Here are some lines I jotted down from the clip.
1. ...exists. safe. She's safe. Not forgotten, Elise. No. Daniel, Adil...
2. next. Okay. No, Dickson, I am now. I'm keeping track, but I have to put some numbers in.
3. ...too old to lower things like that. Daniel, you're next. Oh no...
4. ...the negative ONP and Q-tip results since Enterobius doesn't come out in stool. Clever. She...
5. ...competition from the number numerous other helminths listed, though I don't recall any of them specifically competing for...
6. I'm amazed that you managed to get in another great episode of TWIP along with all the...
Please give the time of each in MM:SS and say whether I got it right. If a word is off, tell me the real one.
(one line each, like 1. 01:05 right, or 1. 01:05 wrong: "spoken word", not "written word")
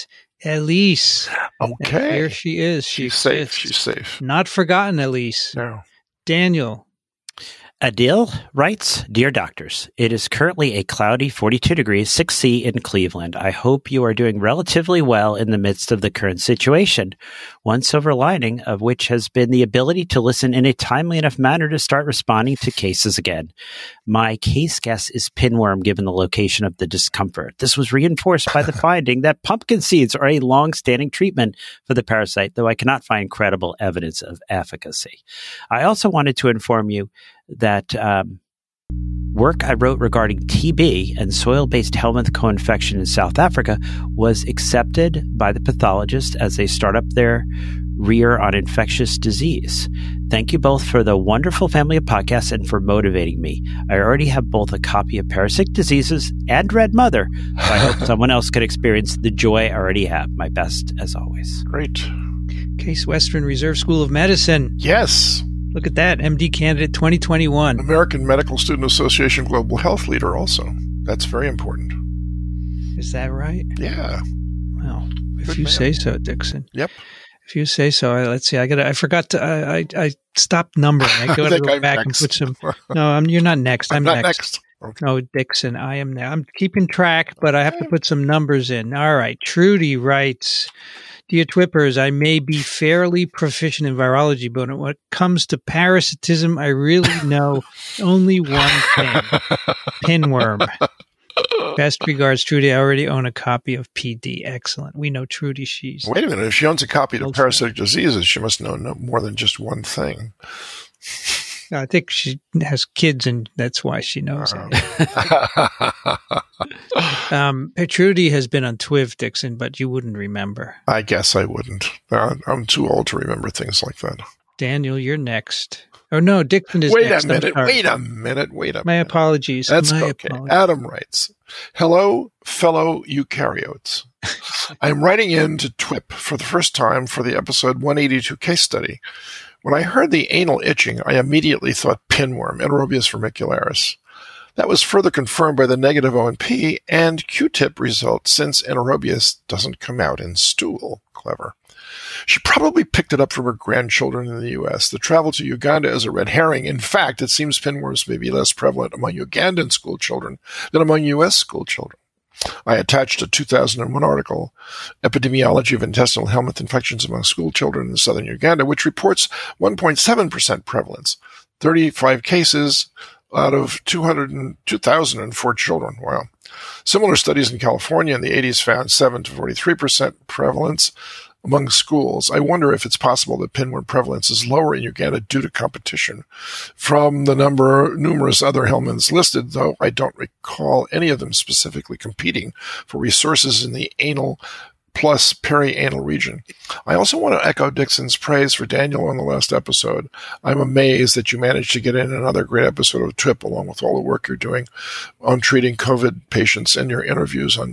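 1. 00:03 right
2. 01:24 right
3. 02:02 wrong: "remember", not "lower"
4. 02:25 right
5. 03:05 right
6. 03:20 right.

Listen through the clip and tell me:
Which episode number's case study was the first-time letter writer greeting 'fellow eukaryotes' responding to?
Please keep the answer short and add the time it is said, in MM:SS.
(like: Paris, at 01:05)
182, at 02:17.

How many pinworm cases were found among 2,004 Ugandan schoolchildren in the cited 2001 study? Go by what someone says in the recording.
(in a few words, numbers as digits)
35.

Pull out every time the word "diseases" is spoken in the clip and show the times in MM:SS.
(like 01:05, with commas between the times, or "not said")
00:49, 00:55, 01:47.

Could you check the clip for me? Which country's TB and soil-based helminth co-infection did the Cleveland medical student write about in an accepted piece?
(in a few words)
South Africa.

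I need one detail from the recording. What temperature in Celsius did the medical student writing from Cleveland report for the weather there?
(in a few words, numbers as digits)
6C.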